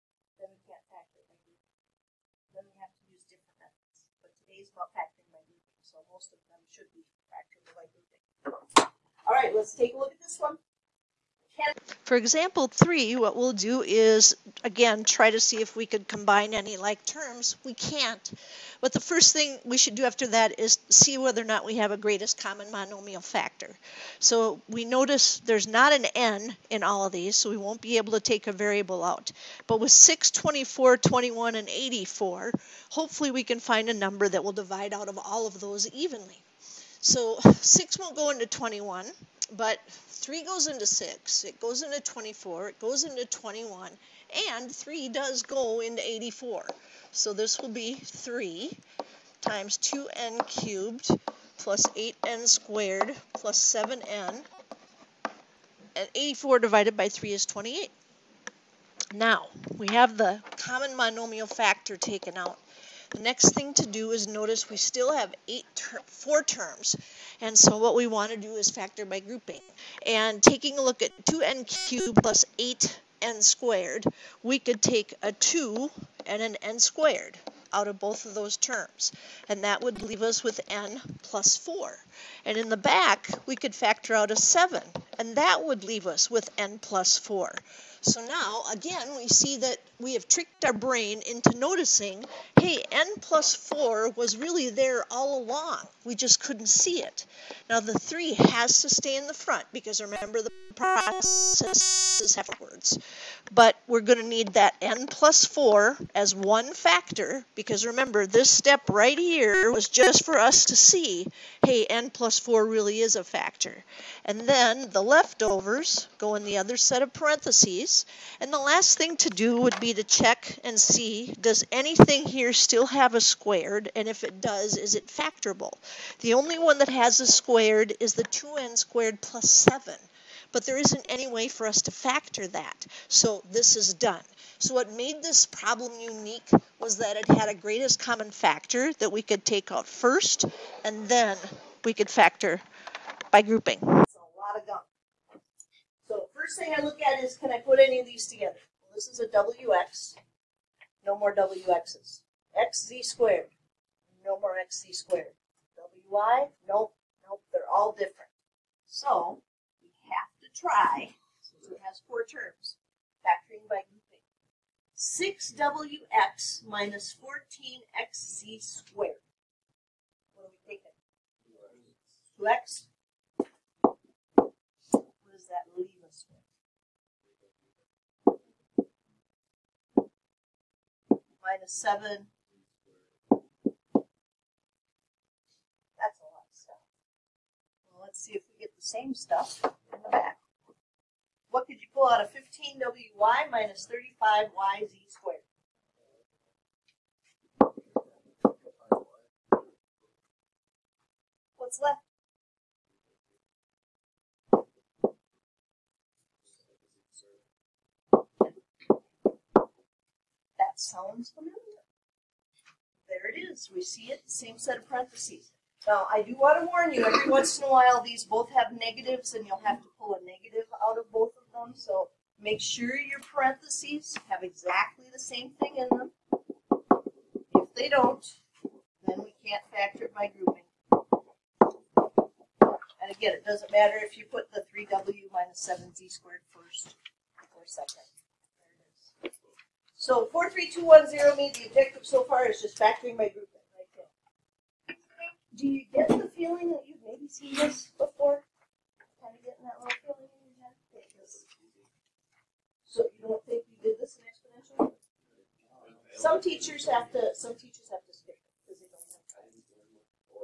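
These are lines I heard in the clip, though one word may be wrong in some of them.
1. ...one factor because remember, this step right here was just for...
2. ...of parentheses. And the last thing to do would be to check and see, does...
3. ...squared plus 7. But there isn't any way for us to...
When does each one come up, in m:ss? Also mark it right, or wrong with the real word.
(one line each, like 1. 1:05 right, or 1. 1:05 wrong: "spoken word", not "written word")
1. 1:46 right
2. 1:57 right
3. 2:08 right.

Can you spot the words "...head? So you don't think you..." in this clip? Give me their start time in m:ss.
4:10.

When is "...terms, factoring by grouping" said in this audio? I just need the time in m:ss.
2:42.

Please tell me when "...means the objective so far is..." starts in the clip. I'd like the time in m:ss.
4:01.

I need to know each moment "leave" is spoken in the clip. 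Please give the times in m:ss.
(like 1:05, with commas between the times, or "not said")
1:20, 1:25.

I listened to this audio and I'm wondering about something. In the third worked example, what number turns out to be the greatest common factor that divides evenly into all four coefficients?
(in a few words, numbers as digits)
3.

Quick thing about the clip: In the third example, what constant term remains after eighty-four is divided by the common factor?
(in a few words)
28.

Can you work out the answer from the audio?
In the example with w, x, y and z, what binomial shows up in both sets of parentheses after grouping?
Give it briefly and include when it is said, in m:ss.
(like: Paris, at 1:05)
3w minus 7z squared, at 3:54.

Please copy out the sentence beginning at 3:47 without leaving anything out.
If they don't, then we can't factor it by grouping.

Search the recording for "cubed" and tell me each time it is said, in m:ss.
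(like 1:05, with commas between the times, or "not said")
0:50, 1:11.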